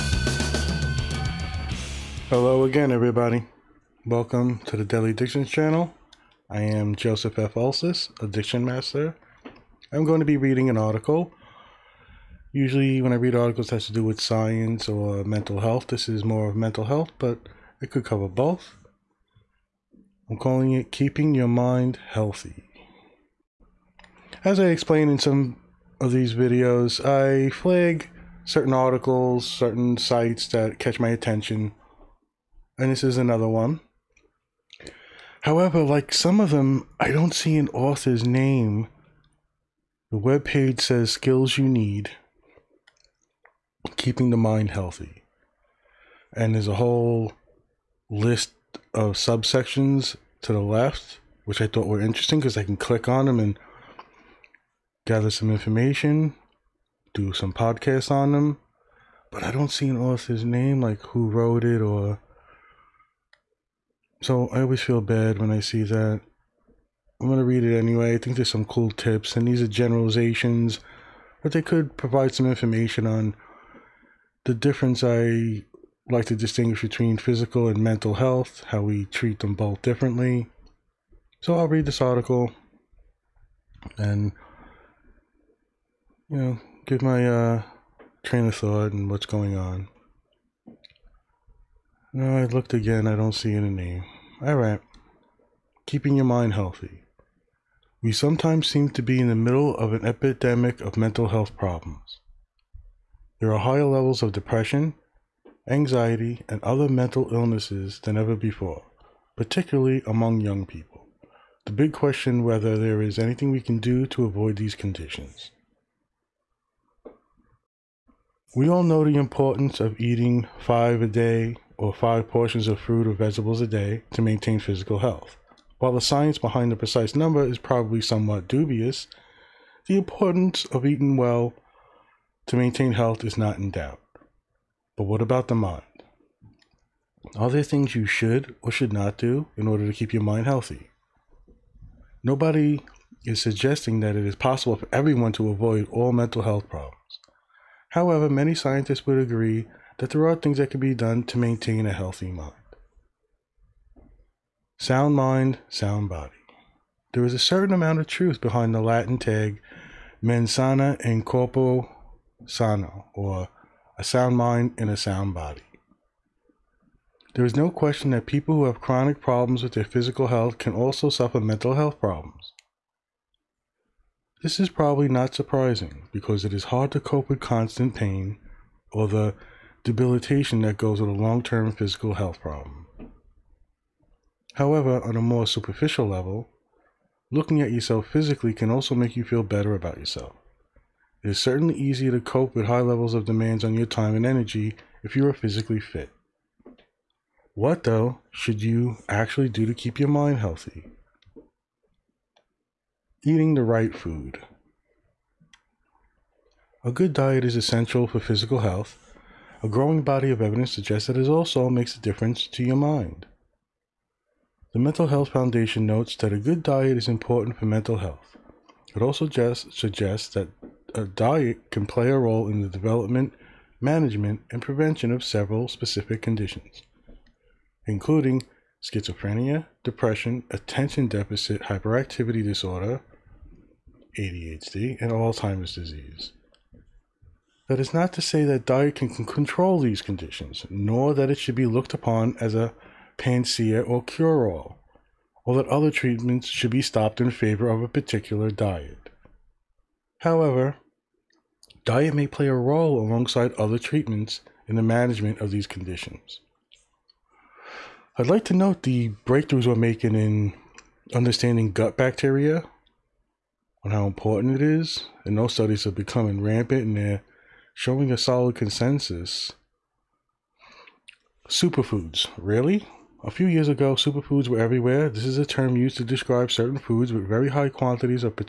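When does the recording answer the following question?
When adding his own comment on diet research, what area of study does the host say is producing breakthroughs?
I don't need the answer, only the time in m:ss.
4:21.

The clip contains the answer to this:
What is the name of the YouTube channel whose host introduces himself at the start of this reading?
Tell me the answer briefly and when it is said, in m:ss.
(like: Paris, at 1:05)
Deadly Addictions, at 0:04.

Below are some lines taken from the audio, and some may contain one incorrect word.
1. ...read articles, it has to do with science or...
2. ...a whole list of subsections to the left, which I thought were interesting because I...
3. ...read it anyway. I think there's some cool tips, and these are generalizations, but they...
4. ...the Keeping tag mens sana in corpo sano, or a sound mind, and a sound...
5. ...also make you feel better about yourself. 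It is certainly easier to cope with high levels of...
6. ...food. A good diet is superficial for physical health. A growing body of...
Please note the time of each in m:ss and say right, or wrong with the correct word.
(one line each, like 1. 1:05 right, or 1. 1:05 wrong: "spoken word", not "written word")
1. 0:13 right
2. 0:46 right
3. 1:07 right
4. 2:38 wrong: "Latin", not "Keeping"
5. 3:08 right
6. 3:23 wrong: "essential", not "superficial".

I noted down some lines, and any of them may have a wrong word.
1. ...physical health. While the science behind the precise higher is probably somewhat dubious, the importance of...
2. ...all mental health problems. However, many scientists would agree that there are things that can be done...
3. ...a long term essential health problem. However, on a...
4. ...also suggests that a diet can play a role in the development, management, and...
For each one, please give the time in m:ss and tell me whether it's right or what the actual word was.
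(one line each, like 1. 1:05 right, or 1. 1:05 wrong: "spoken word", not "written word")
1. 2:04 wrong: "number", not "higher"
2. 2:25 right
3. 3:01 wrong: "physical", not "essential"
4. 3:39 right.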